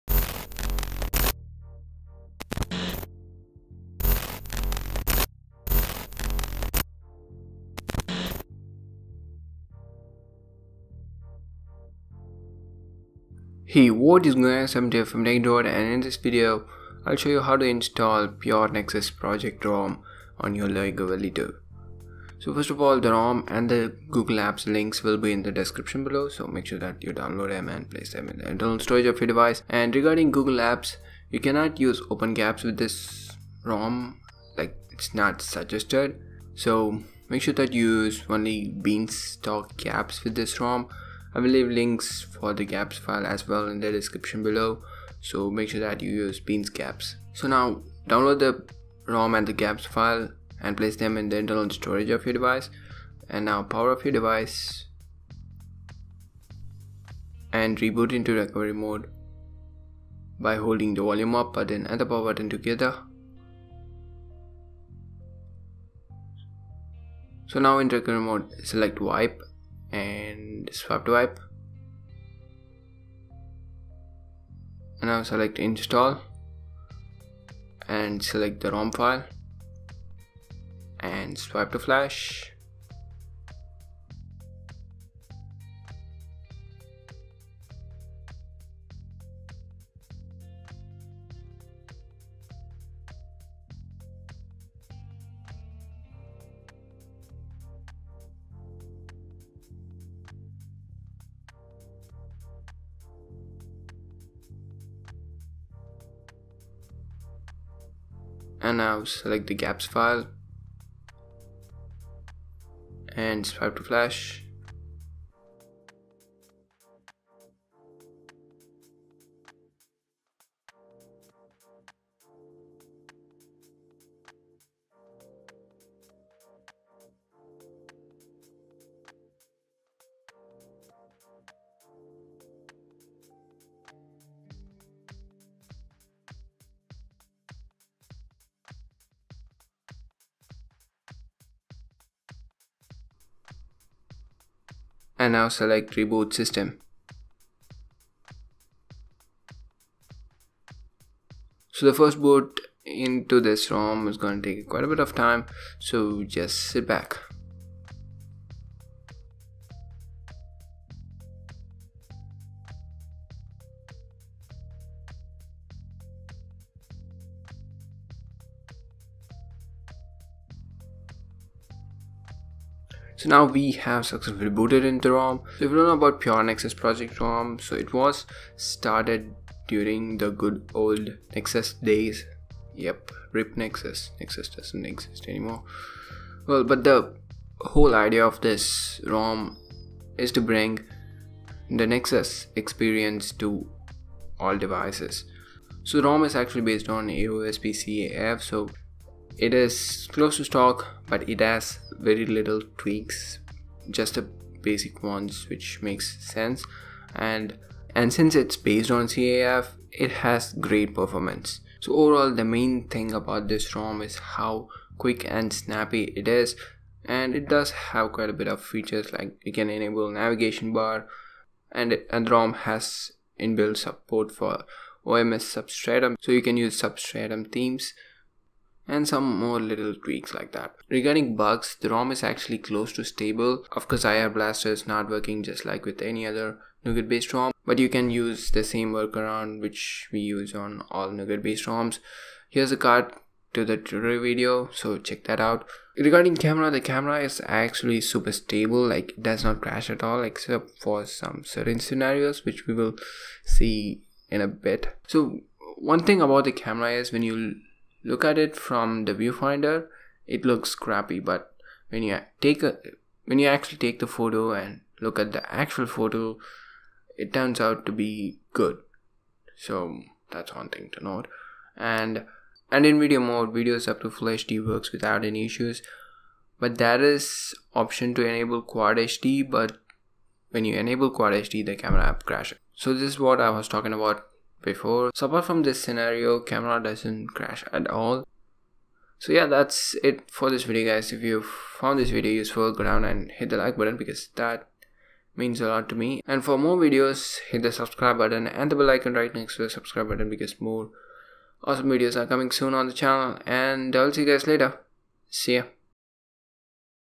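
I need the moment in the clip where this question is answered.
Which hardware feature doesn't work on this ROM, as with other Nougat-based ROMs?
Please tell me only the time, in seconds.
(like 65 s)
234 s.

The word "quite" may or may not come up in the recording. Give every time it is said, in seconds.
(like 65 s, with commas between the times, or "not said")
154 s, 218 s.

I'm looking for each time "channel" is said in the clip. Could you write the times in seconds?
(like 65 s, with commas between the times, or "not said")
302 s.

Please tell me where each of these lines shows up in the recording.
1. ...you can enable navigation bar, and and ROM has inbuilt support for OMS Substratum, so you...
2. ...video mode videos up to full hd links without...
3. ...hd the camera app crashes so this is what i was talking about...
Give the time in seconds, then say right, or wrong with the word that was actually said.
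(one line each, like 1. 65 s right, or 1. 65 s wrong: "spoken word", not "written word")
1. 219 s right
2. 272 s wrong: "works", not "links"
3. 281 s right.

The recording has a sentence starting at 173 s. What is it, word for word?
So now we have successfully booted into ROM.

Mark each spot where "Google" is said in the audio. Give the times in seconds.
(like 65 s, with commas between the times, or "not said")
24 s, 30 s.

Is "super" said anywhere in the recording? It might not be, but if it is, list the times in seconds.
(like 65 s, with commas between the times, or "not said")
247 s.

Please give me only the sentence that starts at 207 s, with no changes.
And and since it's based on CAF, it has great performance.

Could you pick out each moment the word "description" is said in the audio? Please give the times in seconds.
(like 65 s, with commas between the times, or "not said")
25 s, 43 s.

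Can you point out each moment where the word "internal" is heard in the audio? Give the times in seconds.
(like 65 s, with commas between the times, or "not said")
28 s, 51 s.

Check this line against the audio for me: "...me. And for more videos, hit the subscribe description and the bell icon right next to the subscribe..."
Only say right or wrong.
wrong.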